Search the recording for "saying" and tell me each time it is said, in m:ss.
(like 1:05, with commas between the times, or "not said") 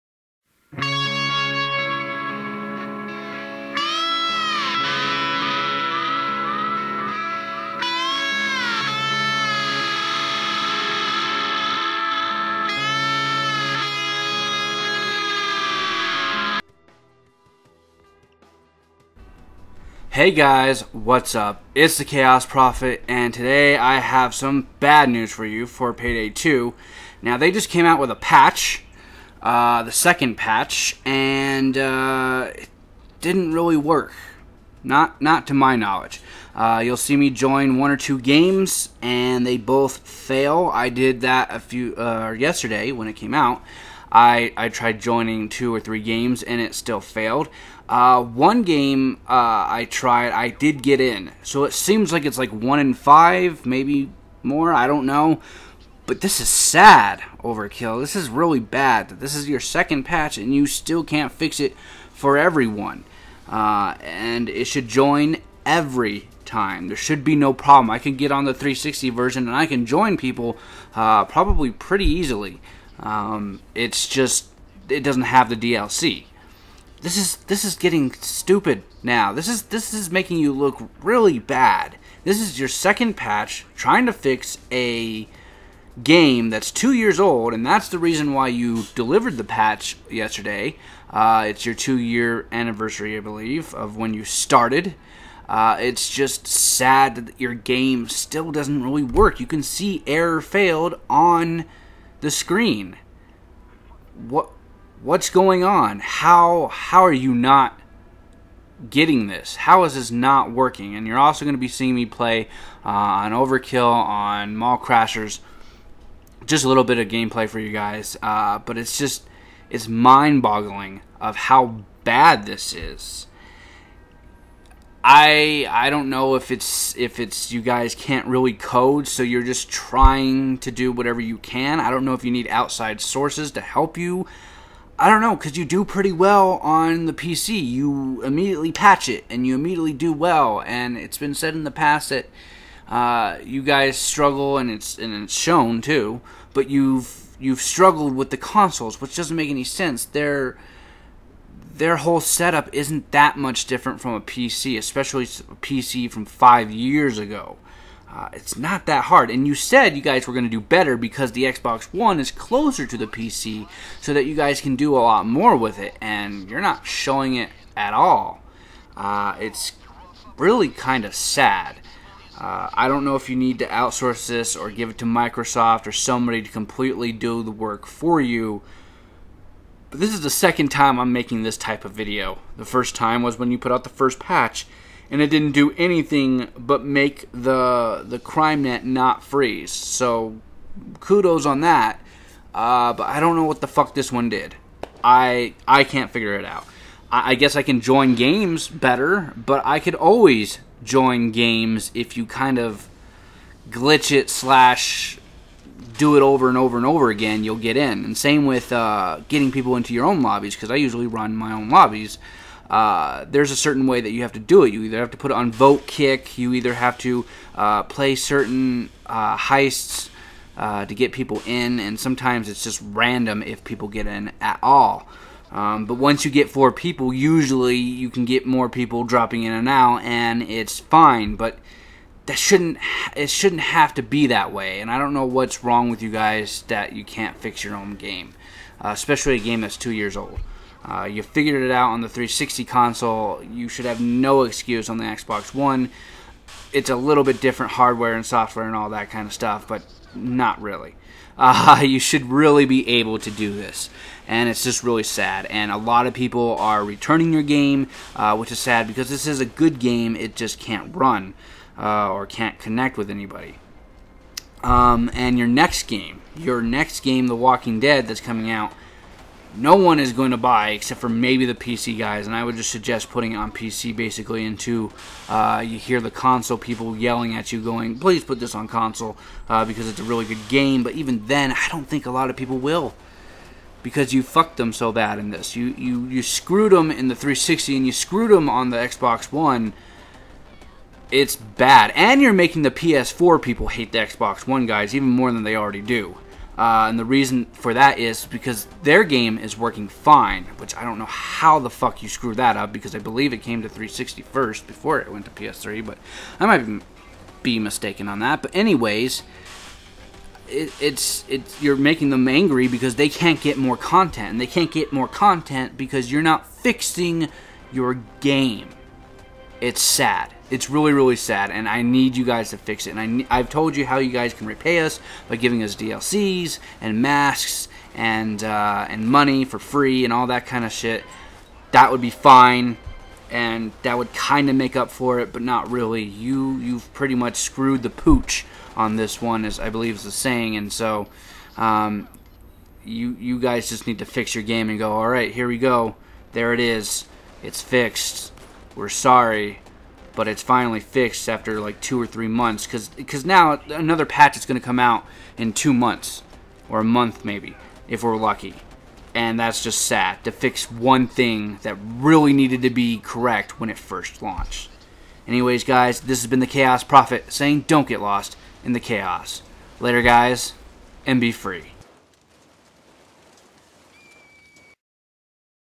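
5:40, 6:07.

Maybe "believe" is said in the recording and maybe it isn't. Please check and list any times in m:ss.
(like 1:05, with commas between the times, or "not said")
1:33, 5:02, 5:39.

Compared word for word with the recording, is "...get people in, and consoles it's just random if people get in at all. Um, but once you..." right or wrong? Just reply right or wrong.
wrong.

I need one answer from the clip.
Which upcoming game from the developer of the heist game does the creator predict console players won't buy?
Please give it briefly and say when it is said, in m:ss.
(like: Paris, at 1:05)
The Walking Dead, at 4:27.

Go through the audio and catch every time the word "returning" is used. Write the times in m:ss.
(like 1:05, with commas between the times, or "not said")
4:16.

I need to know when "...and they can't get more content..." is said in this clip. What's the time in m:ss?
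5:14.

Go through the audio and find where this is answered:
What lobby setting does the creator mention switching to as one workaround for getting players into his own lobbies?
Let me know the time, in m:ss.
3:35.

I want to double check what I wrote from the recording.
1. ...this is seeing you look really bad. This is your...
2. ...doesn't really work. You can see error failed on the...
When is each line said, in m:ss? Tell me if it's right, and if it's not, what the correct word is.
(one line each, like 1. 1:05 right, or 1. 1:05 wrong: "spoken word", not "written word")
1. 1:19 wrong: "making", not "seeing"
2. 1:38 right.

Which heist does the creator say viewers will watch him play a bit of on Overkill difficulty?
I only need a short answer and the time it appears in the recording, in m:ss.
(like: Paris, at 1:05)
Mall Crashers, at 1:54.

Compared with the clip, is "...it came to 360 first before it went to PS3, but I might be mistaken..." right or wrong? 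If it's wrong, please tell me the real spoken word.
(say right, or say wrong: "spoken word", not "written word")
right.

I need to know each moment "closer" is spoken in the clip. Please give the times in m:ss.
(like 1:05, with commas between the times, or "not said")
2:42.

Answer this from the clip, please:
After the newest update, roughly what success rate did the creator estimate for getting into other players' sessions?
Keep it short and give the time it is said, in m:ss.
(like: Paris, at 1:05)
1 in 5, at 0:52.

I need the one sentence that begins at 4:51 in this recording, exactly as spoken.
And you're making the PS4 people hate the Xbox One guys even more than they already do.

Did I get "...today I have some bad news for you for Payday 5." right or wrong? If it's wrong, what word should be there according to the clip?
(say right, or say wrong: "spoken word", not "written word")
wrong: "2", not "5".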